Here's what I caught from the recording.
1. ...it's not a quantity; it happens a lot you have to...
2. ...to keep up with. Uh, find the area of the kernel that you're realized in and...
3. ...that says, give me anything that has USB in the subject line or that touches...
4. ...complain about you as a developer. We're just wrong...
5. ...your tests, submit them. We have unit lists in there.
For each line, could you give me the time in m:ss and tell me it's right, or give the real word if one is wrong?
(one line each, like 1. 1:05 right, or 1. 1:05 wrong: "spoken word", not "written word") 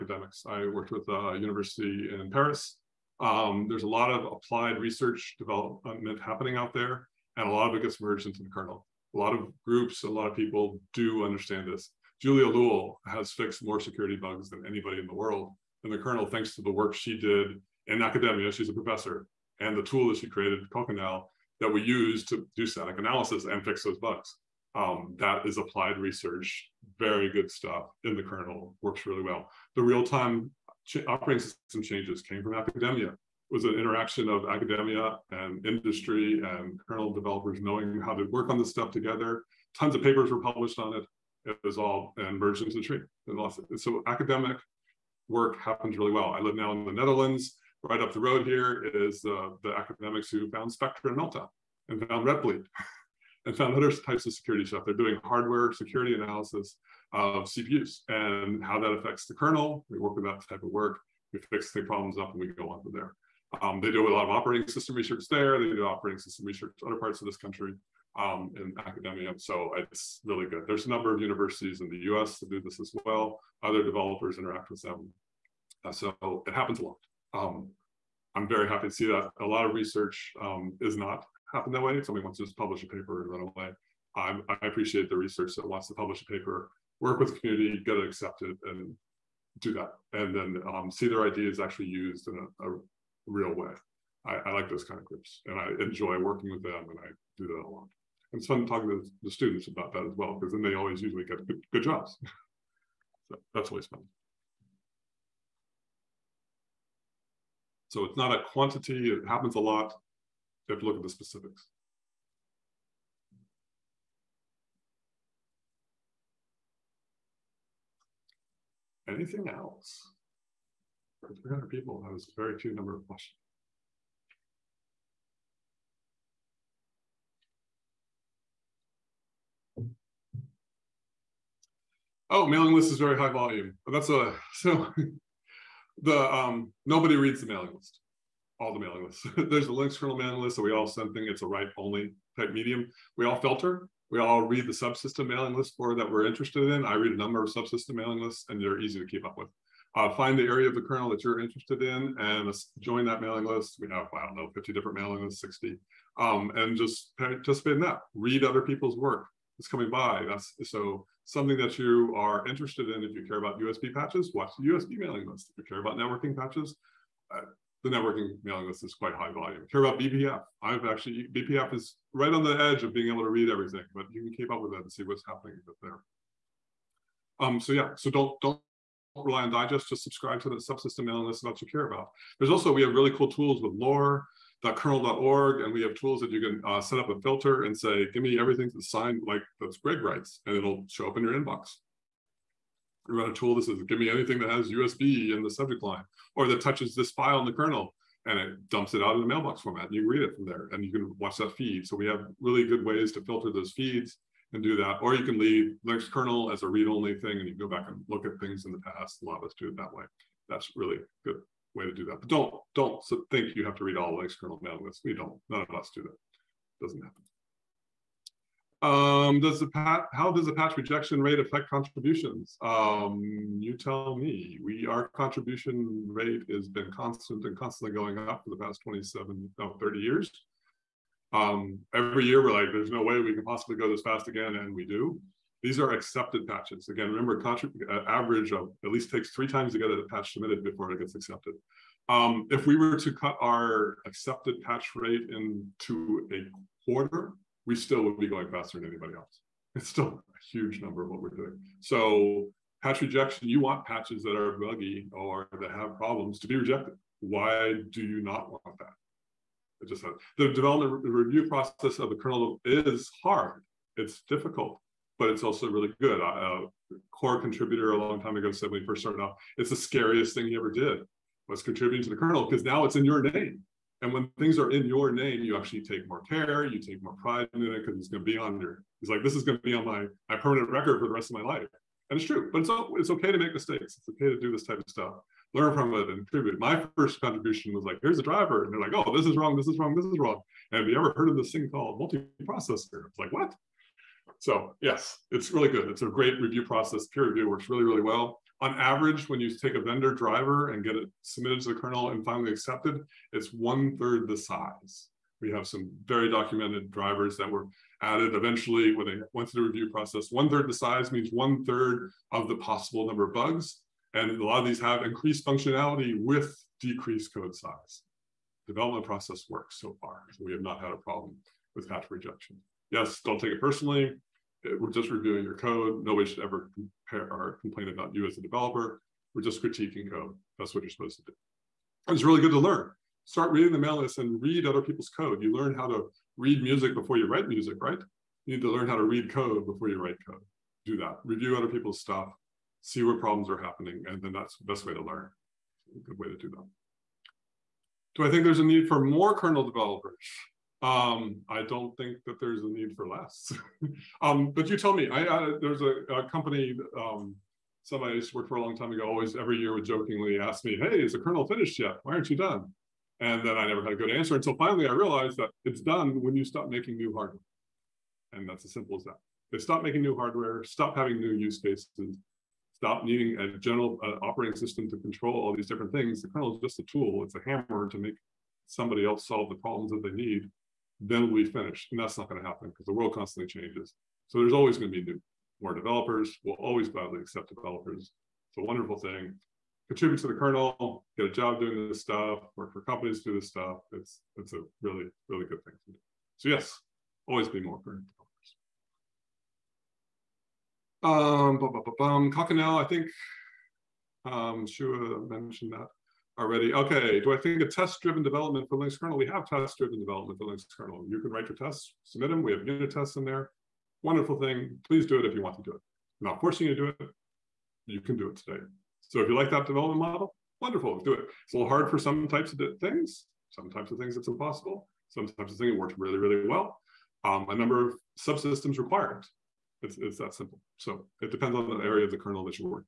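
1. 1:48 right
2. 2:28 wrong: "interested", not "realized"
3. 3:13 right
4. 5:27 wrong: "critiquing", not "wrong"
5. 6:51 wrong: "tests", not "lists".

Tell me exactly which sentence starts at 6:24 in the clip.
So there's always going to be new, more developers.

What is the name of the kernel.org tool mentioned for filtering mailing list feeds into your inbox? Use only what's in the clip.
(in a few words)
lore.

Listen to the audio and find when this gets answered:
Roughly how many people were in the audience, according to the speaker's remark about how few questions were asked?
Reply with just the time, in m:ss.
2:01.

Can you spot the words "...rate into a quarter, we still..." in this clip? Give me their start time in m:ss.
4:04.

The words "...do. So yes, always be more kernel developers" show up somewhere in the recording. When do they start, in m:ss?
6:35.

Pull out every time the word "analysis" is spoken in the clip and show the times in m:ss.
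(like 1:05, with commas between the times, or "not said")
0:22, 0:56.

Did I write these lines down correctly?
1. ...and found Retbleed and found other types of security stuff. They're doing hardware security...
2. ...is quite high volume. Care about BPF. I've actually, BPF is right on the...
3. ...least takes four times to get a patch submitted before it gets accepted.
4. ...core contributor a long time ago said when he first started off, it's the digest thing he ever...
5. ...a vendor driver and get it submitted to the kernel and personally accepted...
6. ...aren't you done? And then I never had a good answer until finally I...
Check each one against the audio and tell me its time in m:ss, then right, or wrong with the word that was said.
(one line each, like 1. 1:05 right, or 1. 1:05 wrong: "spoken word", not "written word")
1. 0:51 right
2. 2:48 right
3. 3:58 wrong: "three", not "four"
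4. 4:27 wrong: "scariest", not "digest"
5. 4:59 wrong: "finally", not "personally"
6. 6:02 right.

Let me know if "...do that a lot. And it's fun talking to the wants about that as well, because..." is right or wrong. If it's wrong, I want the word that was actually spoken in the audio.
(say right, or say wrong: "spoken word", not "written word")
wrong: "students", not "wants".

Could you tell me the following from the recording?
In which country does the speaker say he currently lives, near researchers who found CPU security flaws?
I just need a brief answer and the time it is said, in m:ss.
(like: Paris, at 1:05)
the Netherlands, at 0:46.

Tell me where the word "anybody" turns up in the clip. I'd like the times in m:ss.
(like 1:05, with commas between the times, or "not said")
0:14, 4:08.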